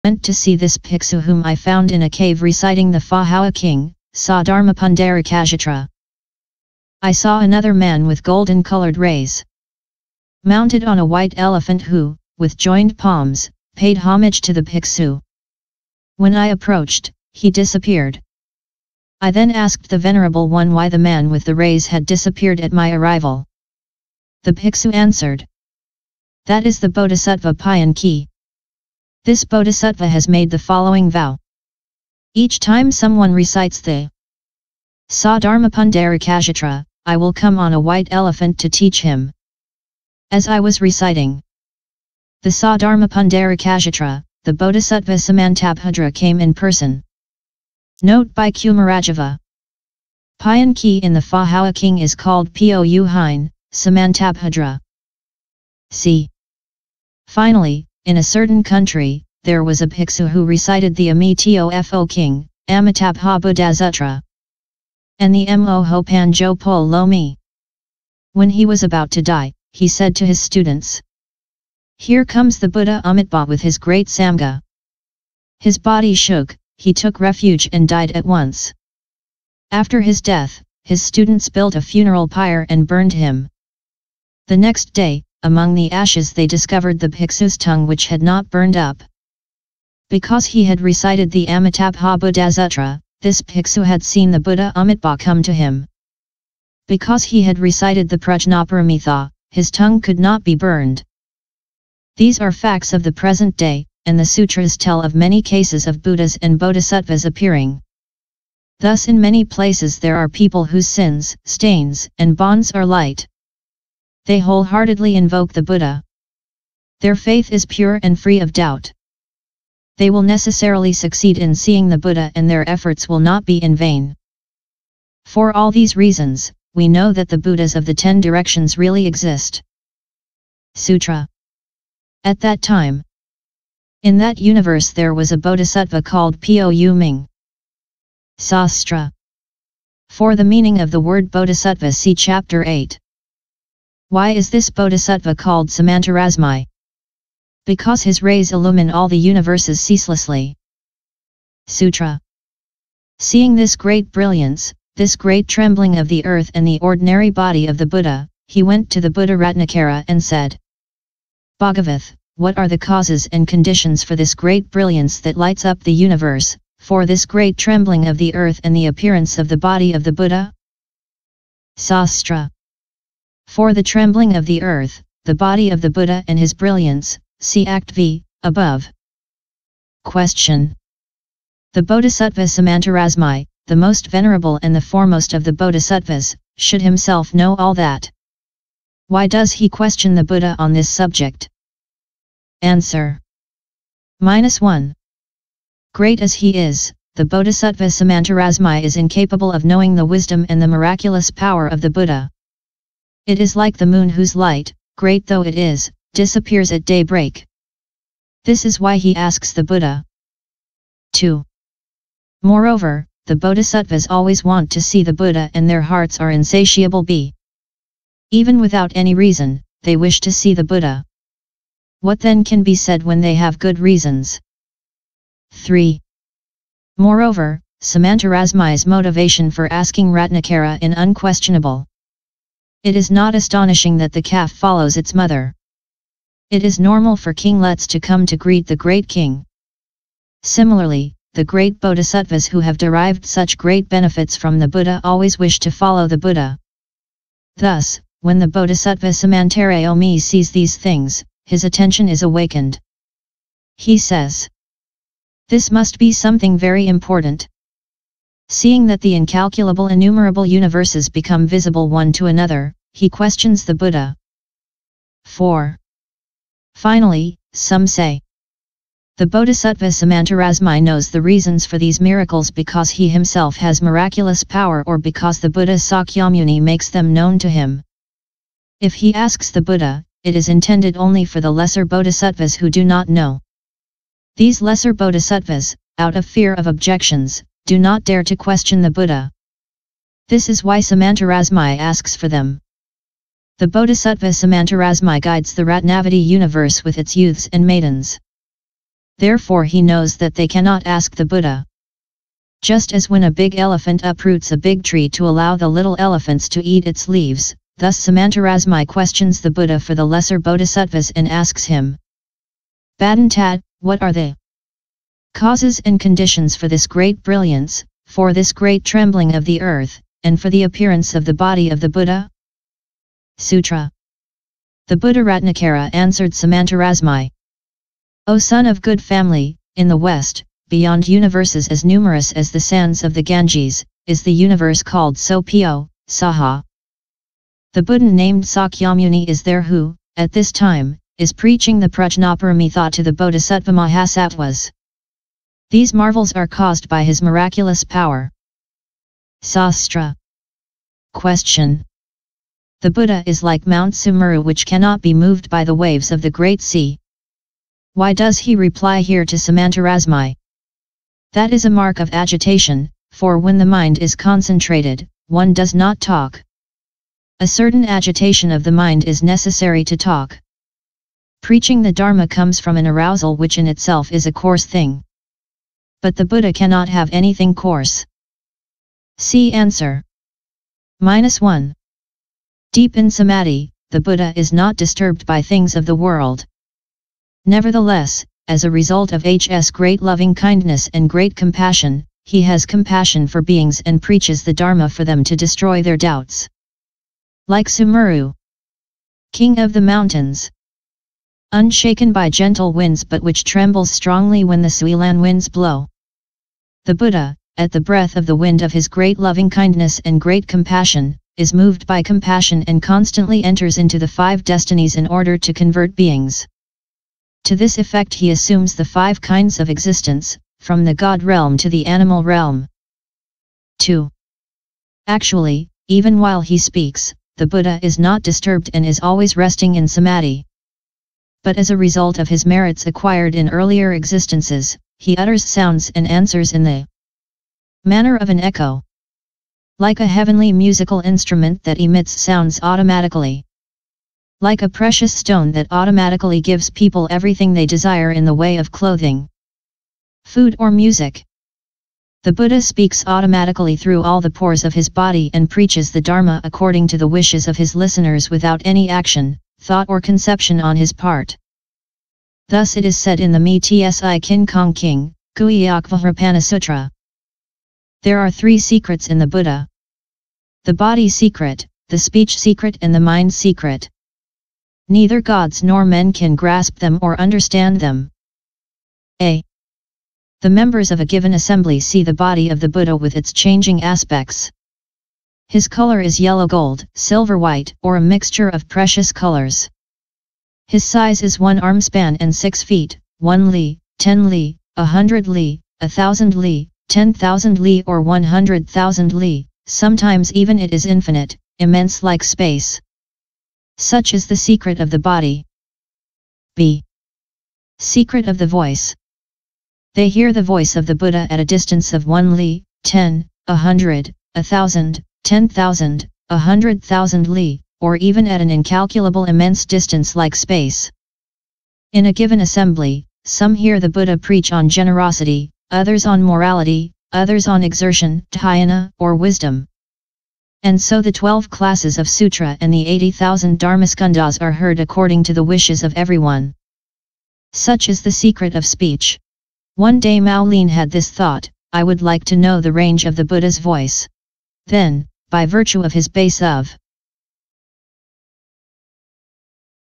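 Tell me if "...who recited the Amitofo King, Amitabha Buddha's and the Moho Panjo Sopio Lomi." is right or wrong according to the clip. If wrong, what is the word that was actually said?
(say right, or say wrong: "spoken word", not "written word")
wrong: "Pol", not "Sopio".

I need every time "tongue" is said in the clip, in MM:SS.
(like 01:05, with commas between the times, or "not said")
01:27, 01:39.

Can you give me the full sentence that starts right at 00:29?
This bodhisattva has made the following vow.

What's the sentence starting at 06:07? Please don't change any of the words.
A certain agitation of the mind is necessary to talk.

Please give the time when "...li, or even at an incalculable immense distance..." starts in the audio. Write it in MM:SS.
08:37.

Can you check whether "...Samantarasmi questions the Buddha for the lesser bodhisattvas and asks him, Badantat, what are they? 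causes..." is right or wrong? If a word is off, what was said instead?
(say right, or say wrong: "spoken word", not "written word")
right.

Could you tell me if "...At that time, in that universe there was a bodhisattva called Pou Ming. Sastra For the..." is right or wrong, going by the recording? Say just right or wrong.
right.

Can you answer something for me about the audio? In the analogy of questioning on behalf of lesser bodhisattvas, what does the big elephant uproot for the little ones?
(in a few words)
a big tree.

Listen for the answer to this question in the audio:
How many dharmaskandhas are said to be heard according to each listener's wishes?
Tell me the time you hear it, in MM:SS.
08:52.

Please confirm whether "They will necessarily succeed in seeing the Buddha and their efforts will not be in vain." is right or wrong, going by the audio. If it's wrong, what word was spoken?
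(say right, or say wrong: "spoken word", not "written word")
right.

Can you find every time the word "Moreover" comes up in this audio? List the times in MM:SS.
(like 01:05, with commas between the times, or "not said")
03:32, 03:46.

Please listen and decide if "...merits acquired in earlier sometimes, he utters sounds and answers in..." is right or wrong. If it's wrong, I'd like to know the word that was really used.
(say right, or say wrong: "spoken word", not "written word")
wrong: "existences", not "sometimes".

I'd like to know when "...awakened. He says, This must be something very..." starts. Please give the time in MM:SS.
04:12.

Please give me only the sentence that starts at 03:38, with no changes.
Even without any reason, they wish to see the Buddha.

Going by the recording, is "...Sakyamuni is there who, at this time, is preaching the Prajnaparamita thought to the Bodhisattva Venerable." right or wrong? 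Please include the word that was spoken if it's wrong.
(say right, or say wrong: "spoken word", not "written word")
wrong: "Mahasattvas", not "Venerable".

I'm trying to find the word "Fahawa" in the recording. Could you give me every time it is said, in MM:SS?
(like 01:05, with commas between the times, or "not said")
00:02, 00:51.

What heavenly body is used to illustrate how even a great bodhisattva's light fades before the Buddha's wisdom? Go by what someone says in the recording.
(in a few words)
the moon.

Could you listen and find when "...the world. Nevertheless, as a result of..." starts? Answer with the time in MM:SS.
06:25.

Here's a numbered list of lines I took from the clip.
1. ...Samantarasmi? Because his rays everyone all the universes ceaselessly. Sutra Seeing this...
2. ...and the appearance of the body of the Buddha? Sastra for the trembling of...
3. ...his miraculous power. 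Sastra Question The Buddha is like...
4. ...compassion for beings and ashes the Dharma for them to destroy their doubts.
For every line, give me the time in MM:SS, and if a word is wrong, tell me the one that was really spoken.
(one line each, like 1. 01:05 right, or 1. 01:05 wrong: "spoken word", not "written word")
1. 02:25 wrong: "illumine", not "everyone"
2. 02:48 right
3. 05:47 right
4. 06:32 wrong: "preaches", not "ashes".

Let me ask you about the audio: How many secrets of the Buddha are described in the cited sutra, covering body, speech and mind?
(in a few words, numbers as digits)
3.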